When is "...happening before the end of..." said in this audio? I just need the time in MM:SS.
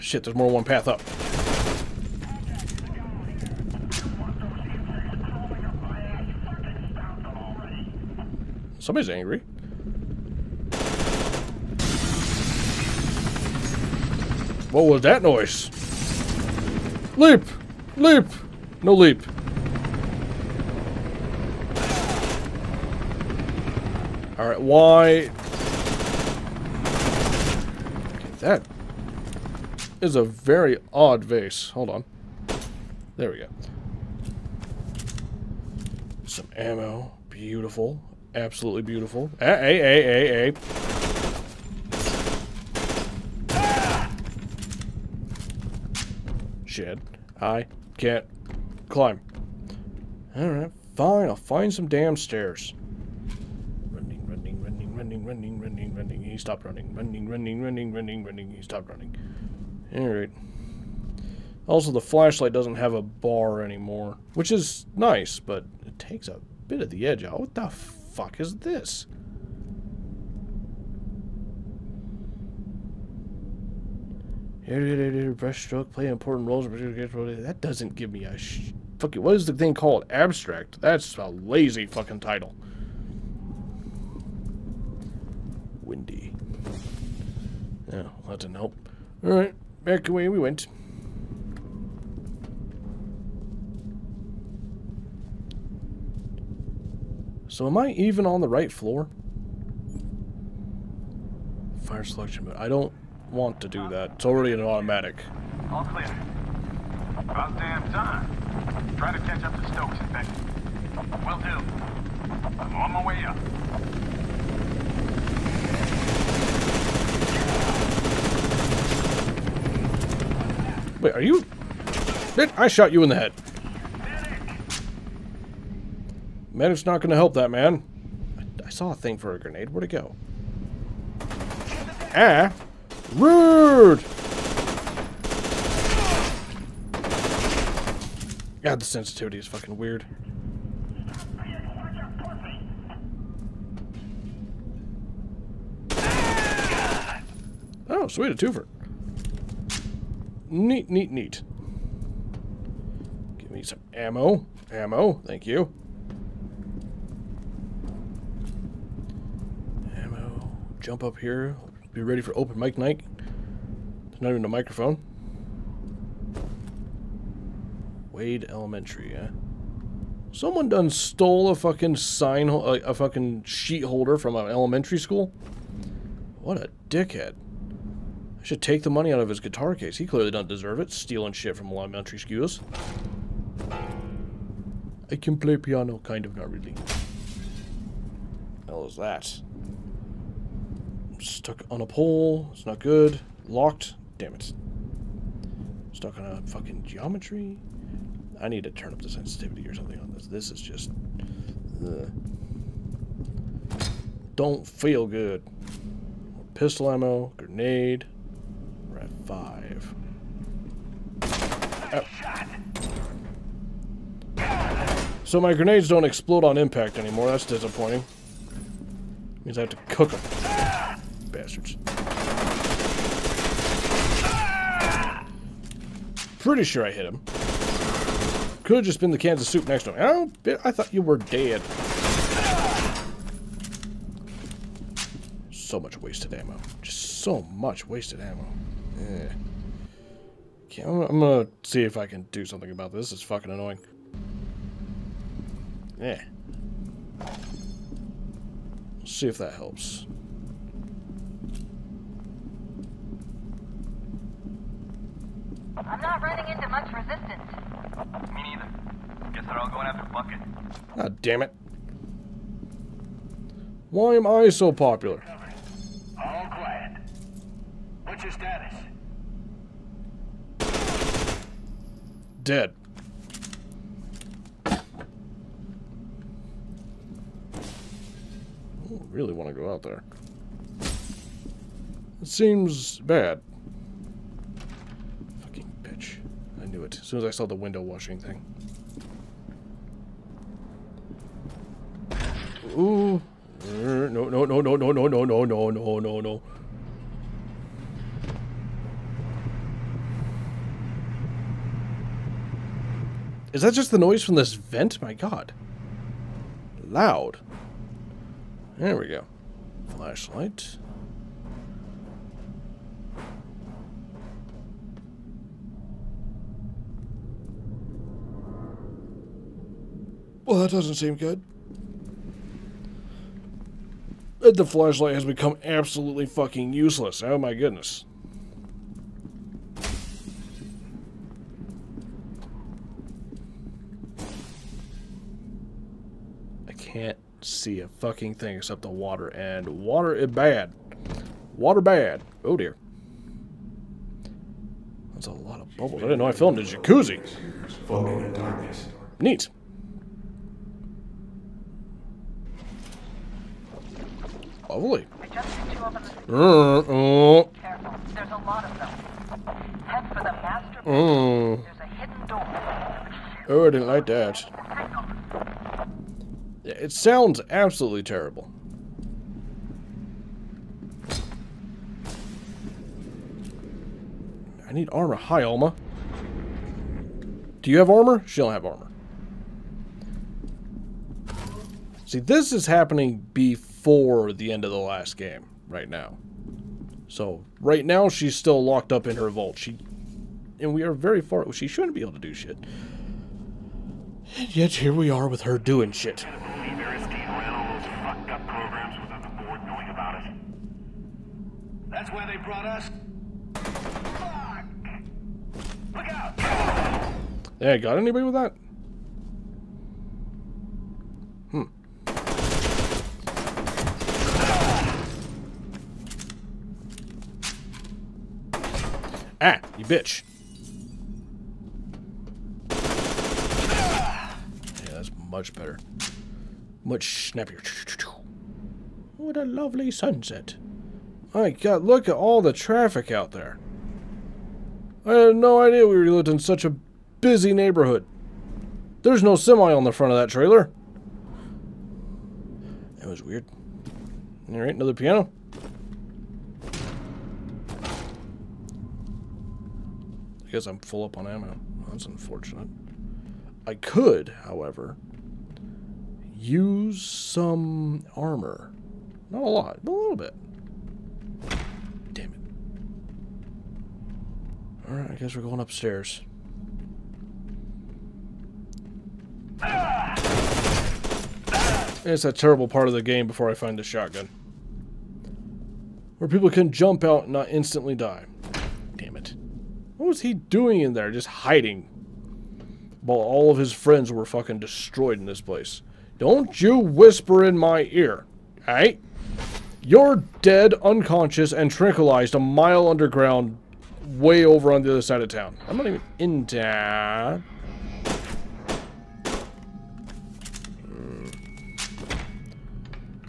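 06:22.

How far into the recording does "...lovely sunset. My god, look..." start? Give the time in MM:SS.
07:09.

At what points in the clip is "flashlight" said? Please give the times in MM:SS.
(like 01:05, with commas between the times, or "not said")
01:01, 05:09, 05:24.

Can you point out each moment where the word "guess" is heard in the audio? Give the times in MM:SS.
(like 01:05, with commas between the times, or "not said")
04:19, 07:45.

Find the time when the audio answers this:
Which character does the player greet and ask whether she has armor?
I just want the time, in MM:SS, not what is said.
06:15.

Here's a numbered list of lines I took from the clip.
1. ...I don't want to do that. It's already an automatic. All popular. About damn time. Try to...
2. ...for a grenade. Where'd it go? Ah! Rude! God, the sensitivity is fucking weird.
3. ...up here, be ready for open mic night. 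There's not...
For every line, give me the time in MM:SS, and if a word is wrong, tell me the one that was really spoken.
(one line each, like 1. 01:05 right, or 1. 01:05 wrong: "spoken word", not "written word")
1. 01:42 wrong: "clear", not "popular"
2. 02:09 right
3. 02:41 right.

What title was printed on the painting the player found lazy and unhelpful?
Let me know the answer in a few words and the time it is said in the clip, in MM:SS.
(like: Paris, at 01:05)
Abstract, at 01:20.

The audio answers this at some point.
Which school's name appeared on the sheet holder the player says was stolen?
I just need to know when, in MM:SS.
02:48.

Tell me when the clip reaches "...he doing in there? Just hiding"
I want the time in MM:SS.
08:00.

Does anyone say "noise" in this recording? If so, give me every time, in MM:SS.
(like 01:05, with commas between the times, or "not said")
00:15, 05:03.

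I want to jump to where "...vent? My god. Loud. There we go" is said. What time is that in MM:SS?
05:04.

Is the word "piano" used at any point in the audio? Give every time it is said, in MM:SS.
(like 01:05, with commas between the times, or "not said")
03:05, 07:24.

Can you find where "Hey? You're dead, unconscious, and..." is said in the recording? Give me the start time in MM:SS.
08:08.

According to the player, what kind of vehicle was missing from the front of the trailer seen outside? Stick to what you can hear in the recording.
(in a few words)
semi.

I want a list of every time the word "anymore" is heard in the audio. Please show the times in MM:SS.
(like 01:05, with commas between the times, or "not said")
01:03, 03:36.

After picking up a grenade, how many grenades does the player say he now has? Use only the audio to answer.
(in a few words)
5.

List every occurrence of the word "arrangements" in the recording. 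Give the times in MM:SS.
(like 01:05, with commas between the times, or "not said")
not said.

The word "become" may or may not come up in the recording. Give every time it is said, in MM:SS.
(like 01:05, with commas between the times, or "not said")
05:25.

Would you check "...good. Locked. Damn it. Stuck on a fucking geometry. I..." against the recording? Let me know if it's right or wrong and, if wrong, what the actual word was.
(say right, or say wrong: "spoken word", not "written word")
right.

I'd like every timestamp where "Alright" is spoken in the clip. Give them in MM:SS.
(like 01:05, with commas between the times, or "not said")
00:24, 00:50, 00:59, 07:24, 07:44.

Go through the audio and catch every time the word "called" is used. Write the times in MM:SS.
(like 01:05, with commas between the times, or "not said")
01:19.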